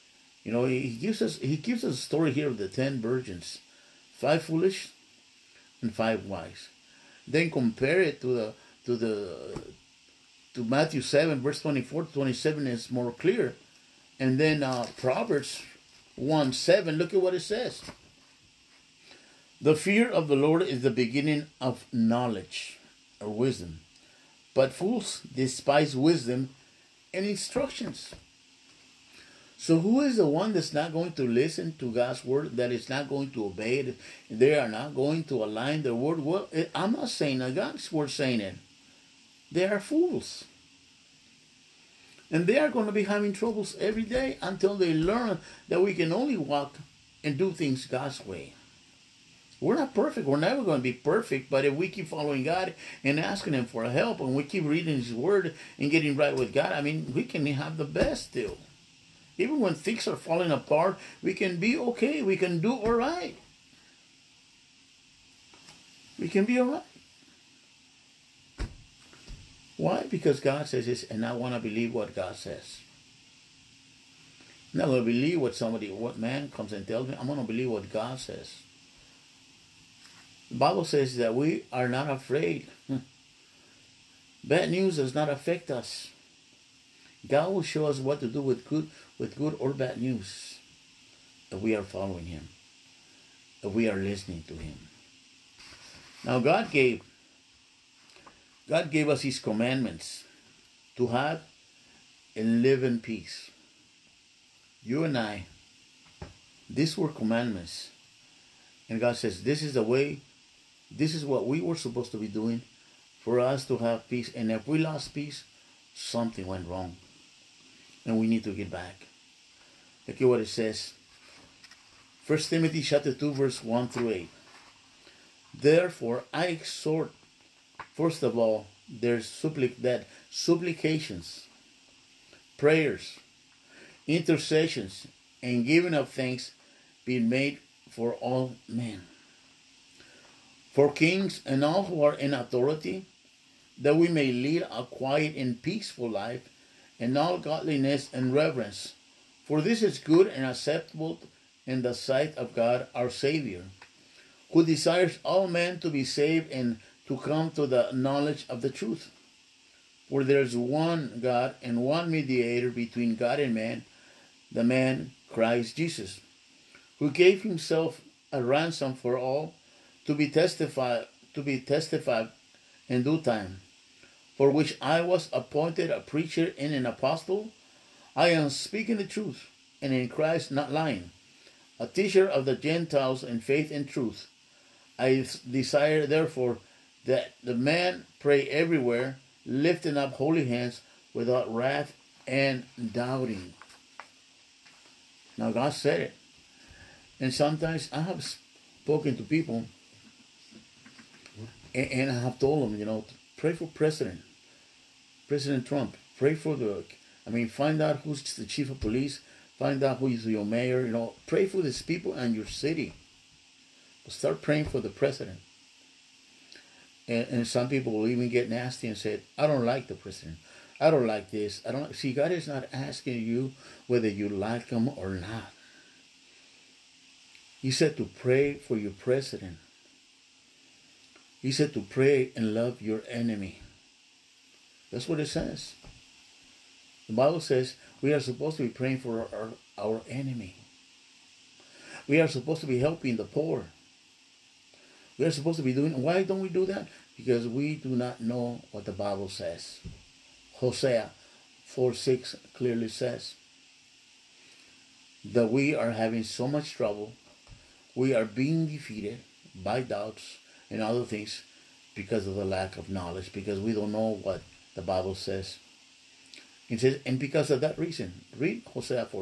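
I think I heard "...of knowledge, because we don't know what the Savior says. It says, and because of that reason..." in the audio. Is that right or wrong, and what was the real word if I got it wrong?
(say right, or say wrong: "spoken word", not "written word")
wrong: "Bible", not "Savior".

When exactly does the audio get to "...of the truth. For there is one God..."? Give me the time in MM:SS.
02:38.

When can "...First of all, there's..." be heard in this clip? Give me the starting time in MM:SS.
02:07.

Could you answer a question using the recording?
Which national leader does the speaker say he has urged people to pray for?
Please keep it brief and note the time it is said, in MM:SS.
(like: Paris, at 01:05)
President Trump, at 03:25.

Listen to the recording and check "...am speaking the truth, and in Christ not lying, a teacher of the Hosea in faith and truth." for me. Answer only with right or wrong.
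wrong.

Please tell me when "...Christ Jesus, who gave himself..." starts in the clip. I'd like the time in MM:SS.
02:45.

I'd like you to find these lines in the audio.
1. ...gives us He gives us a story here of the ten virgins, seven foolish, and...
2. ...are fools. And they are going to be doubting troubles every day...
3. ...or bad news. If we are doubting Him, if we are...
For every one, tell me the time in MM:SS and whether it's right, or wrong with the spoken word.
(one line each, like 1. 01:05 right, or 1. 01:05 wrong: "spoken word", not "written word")
1. 00:00 wrong: "five", not "seven"
2. 00:39 wrong: "having", not "doubting"
3. 01:29 wrong: "following", not "doubting".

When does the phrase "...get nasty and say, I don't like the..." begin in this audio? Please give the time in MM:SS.
03:38.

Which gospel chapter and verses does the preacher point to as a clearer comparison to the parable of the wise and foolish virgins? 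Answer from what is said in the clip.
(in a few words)
Matthew 7:24-27.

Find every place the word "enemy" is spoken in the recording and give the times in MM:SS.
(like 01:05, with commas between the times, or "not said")
03:53, 04:00.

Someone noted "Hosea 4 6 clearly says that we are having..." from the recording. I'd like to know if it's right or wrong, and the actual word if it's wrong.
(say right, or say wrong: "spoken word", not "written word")
right.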